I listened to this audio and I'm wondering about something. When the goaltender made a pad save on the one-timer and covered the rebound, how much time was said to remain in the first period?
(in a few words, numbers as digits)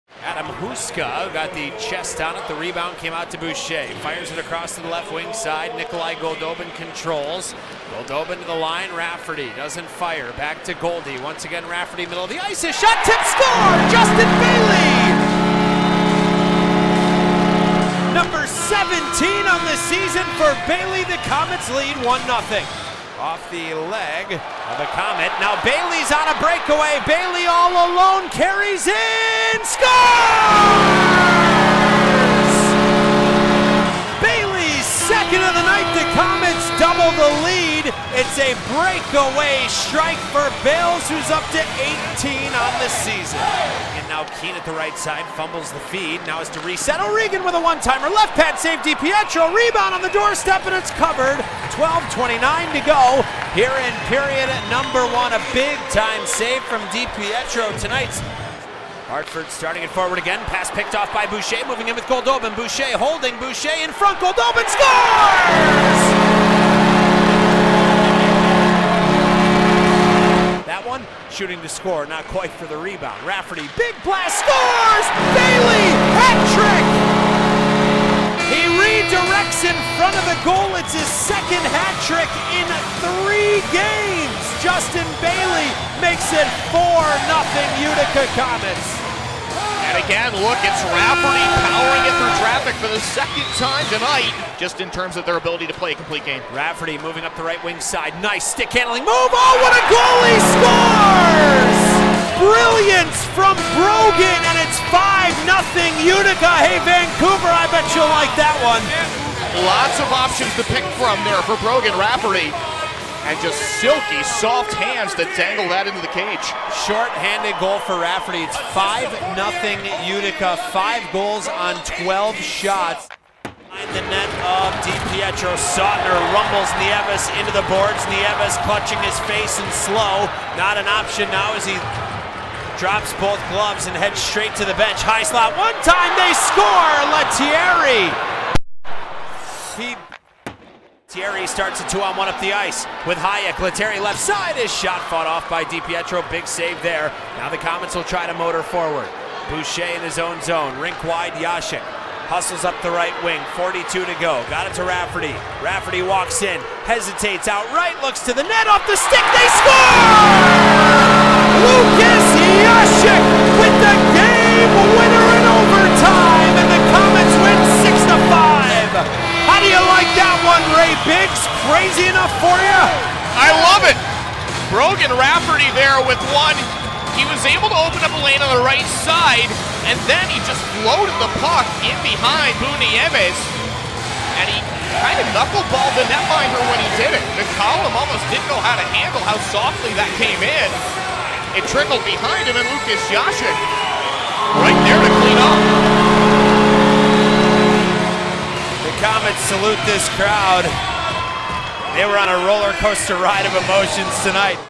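12:29.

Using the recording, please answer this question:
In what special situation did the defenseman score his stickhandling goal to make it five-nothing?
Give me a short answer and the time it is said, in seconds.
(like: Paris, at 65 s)
Short-handed, at 116 s.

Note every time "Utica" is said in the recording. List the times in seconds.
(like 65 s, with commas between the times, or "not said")
87 s, 106 s, 120 s.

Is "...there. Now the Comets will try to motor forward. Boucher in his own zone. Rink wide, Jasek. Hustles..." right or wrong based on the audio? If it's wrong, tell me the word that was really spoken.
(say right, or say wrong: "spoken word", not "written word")
right.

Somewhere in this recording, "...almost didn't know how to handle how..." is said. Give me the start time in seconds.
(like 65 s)
187 s.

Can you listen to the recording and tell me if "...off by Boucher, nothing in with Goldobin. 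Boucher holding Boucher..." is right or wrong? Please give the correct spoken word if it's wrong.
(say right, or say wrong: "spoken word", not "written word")
wrong: "moving", not "nothing".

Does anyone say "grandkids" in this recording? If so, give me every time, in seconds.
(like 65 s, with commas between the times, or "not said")
not said.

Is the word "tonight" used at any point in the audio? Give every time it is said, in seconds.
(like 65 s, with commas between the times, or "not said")
57 s, 93 s, 204 s.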